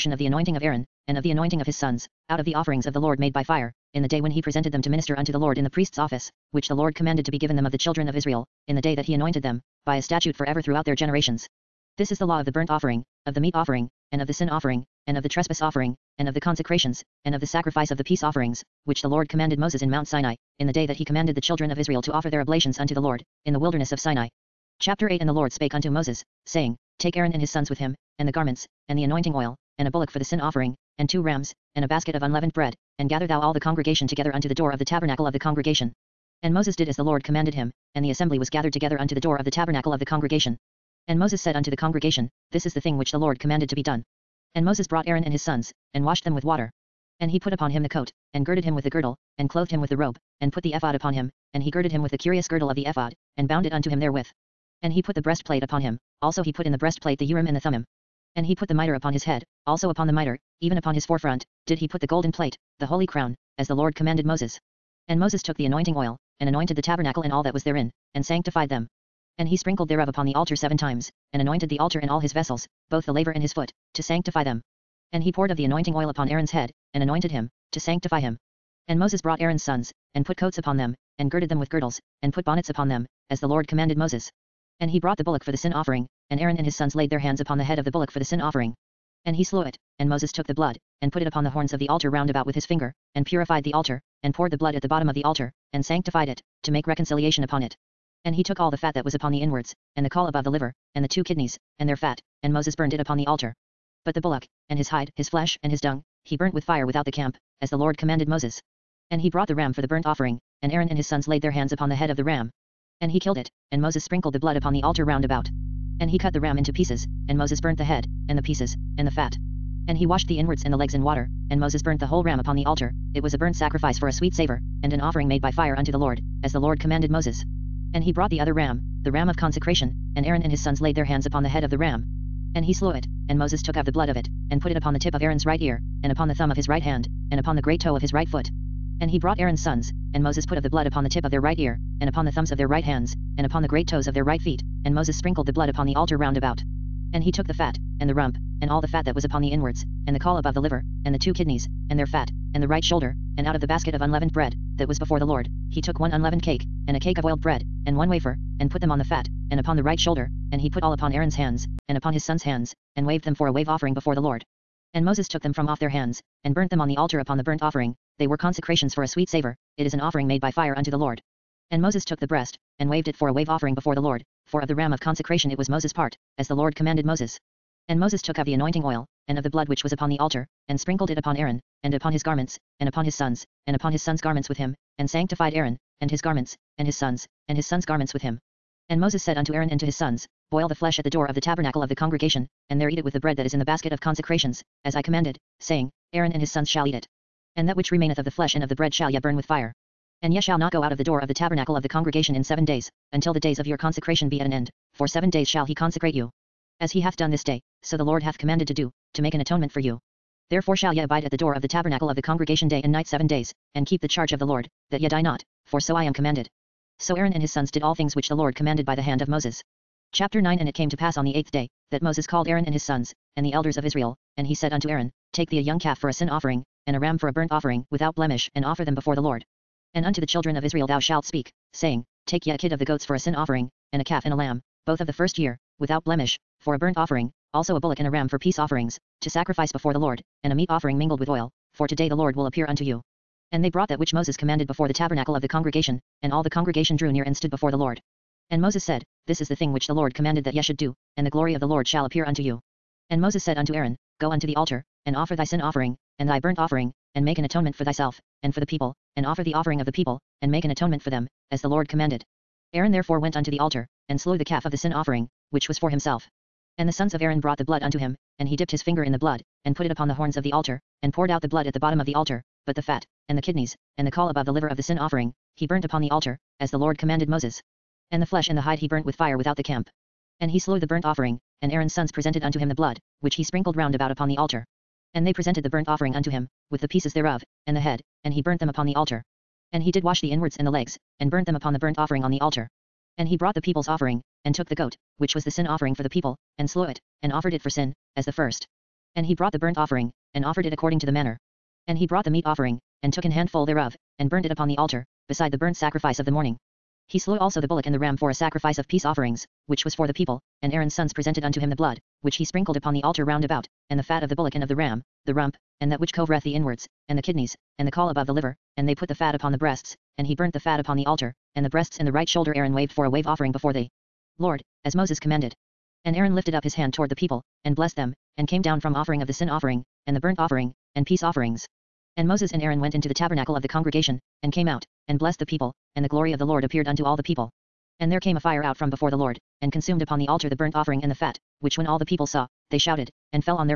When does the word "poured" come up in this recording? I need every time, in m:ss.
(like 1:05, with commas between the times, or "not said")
1:15, 1:34, 4:31.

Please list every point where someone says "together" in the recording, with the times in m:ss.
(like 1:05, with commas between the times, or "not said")
0:34, 0:38.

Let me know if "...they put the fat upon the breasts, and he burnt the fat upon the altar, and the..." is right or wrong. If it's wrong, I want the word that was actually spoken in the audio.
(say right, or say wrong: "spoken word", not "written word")
right.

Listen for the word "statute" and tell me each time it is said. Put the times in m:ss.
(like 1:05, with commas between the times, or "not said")
0:10.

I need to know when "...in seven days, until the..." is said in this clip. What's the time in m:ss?
3:22.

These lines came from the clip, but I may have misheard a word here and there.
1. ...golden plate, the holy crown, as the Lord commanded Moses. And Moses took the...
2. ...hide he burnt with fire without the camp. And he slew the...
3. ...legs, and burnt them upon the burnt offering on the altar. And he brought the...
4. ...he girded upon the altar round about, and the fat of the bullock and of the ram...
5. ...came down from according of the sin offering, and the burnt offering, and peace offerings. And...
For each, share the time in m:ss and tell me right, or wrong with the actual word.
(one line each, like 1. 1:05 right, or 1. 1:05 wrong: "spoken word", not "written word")
1. 1:02 right
2. 4:38 right
3. 4:50 right
4. 5:12 wrong: "sprinkled", not "girded"
5. 5:28 wrong: "offering", not "according".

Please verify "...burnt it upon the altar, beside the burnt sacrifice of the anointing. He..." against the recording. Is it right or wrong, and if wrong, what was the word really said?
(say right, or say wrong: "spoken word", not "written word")
wrong: "morning", not "anointing".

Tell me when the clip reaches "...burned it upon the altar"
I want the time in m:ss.
1:42.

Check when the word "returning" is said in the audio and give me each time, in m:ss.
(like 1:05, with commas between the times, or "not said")
not said.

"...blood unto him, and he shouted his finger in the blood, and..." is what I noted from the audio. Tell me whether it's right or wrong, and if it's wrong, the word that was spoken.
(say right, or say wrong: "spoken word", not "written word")
wrong: "dipped", not "shouted".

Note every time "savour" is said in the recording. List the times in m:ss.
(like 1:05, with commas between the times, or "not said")
2:04, 2:49.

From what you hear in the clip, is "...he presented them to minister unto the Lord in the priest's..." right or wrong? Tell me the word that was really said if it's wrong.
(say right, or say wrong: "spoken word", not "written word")
right.